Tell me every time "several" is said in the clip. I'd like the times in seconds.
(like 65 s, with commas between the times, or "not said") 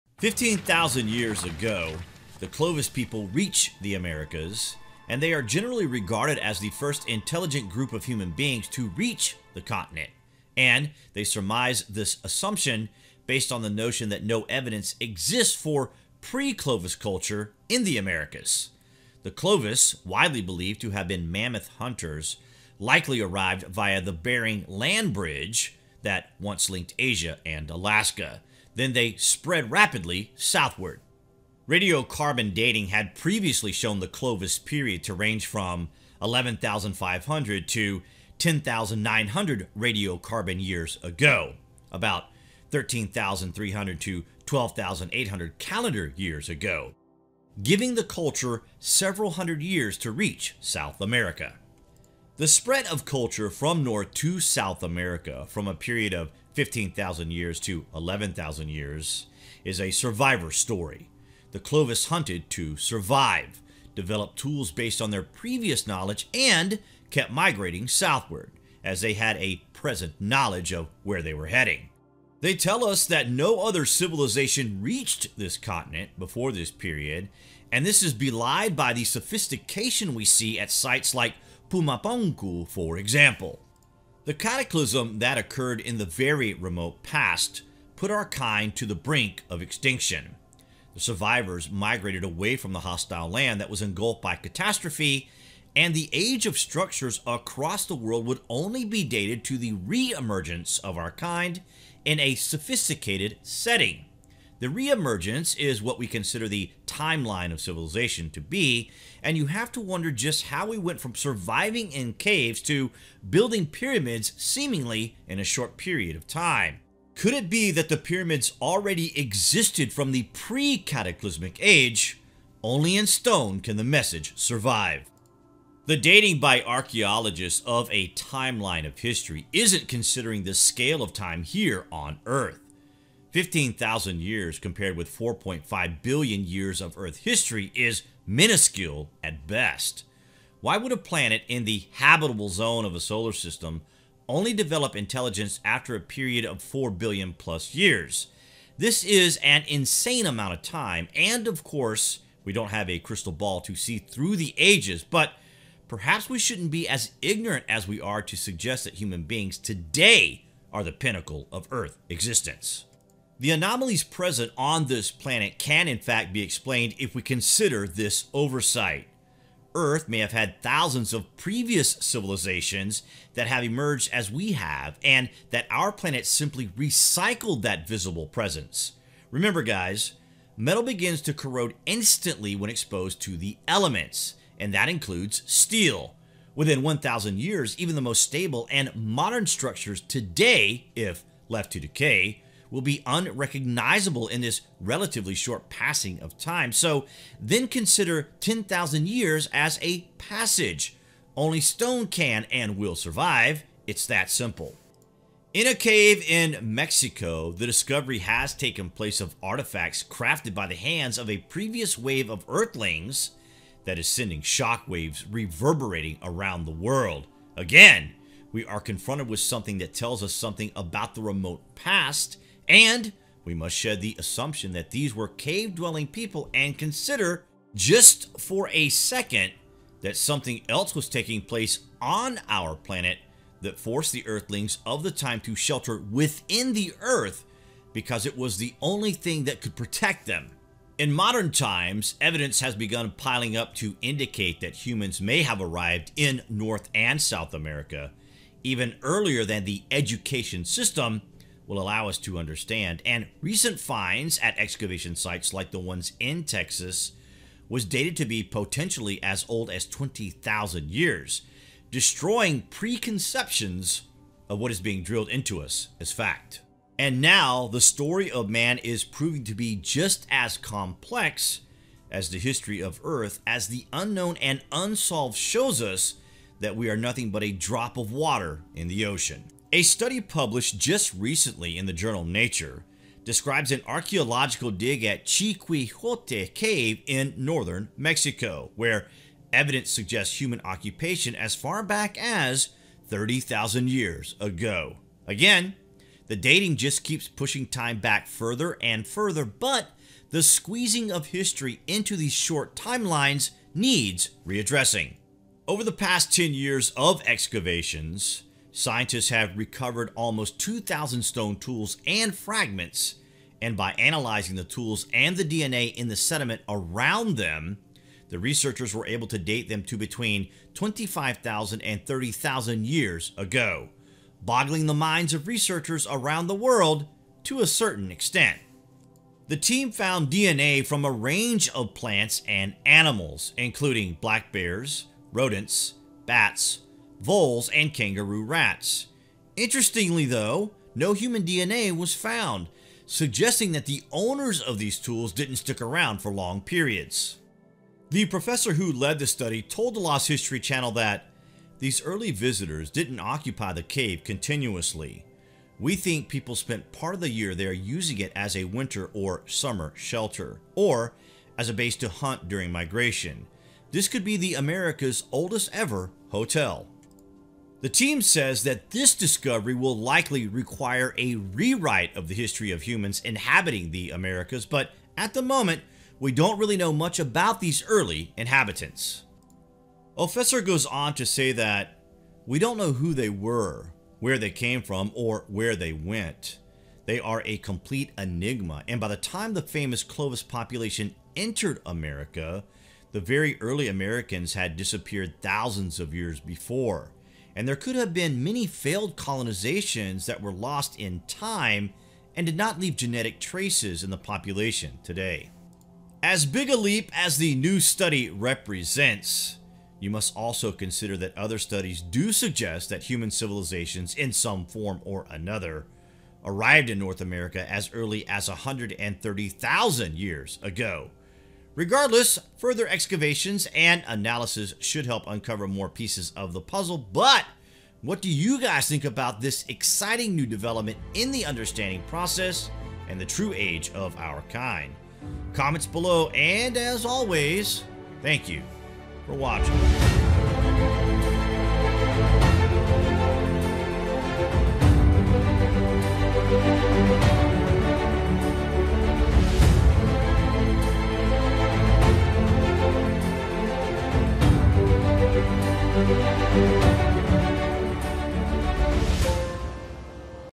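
48 s.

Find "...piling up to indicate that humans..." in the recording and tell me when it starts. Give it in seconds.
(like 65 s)
243 s.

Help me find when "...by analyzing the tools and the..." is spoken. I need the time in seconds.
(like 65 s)
313 s.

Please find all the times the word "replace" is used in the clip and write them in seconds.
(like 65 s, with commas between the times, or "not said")
not said.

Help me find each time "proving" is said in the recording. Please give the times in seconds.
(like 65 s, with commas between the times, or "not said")
269 s.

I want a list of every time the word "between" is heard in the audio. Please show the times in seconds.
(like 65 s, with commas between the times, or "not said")
319 s.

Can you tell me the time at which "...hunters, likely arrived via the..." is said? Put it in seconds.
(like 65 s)
21 s.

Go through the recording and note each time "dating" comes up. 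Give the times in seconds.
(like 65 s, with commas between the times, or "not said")
32 s, 125 s, 296 s.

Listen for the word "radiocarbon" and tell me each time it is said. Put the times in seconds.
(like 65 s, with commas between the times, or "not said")
31 s, 39 s.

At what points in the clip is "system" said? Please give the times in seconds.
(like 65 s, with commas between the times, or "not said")
143 s, 250 s.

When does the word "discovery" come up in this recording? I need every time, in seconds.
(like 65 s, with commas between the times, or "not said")
207 s, 369 s.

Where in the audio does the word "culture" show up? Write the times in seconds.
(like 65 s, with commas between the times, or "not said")
16 s, 48 s, 53 s.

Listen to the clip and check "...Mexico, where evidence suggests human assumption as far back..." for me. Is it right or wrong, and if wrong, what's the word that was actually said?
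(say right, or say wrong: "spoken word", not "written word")
wrong: "occupation", not "assumption".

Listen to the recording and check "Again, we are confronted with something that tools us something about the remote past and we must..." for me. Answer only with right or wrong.
wrong.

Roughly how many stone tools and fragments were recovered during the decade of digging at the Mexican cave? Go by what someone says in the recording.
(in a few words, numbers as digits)
2,000.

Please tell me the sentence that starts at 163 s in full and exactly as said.
The anomalies present on this planet can in fact be explained if we consider this oversight.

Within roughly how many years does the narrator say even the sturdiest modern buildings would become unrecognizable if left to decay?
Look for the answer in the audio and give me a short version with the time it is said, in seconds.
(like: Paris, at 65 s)
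1,000 years, at 186 s.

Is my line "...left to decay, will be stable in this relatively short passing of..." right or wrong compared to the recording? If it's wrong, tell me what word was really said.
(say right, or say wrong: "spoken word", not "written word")
wrong: "unrecognizable", not "stable".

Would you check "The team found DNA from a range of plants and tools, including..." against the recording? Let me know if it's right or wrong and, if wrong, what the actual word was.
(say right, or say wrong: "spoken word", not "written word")
wrong: "animals", not "tools".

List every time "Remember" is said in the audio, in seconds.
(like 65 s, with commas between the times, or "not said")
179 s.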